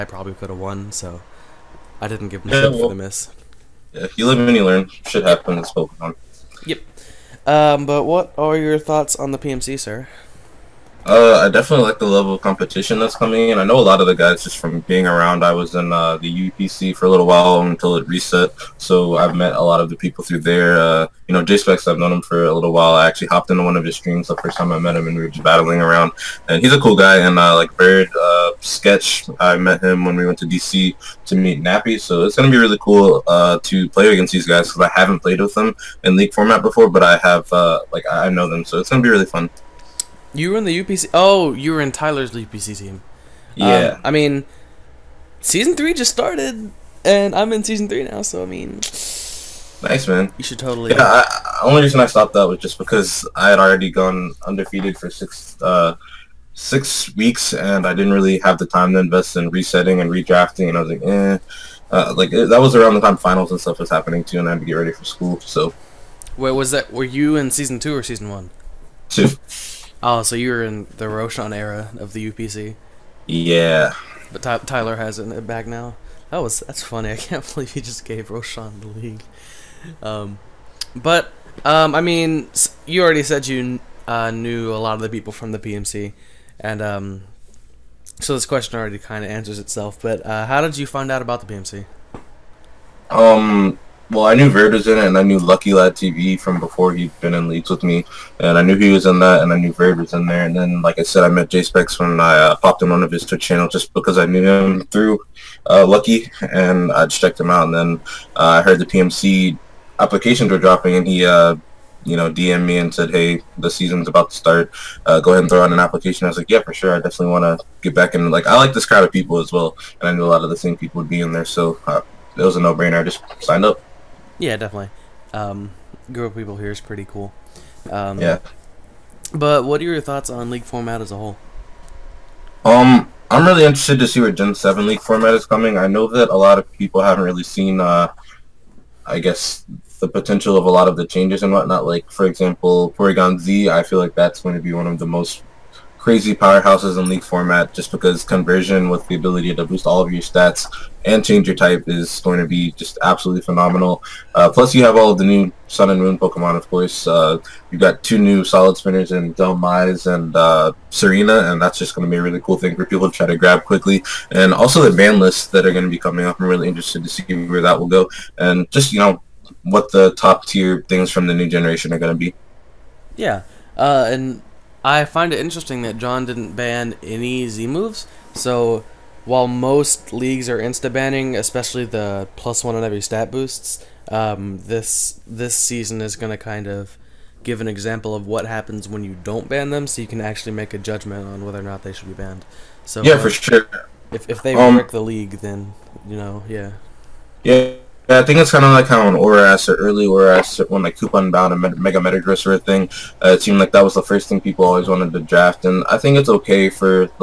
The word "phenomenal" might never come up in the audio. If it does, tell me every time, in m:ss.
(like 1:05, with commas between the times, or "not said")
2:33.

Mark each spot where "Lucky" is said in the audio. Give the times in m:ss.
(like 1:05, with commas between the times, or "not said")
1:35, 1:45.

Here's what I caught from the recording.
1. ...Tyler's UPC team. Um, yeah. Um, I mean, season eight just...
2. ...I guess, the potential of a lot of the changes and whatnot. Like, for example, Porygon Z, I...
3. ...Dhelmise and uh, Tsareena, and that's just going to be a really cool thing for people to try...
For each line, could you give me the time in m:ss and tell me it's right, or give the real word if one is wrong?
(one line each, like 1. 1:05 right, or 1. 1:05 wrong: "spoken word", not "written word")
1. 0:41 wrong: "three", not "eight"
2. 2:19 right
3. 2:39 right.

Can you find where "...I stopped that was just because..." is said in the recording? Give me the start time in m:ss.
0:51.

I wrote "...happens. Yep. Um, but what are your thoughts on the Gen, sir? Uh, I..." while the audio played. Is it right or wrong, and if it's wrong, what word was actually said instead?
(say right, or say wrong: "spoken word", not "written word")
wrong: "PMC", not "Gen".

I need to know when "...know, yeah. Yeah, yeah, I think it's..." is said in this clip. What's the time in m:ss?
3:16.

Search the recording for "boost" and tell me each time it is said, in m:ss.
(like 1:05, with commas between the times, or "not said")
2:29, 3:03.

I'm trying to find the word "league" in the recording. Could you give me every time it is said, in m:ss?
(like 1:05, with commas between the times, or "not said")
0:36, 1:18, 1:37, 2:10, 2:14, 2:27, 3:00, 3:15.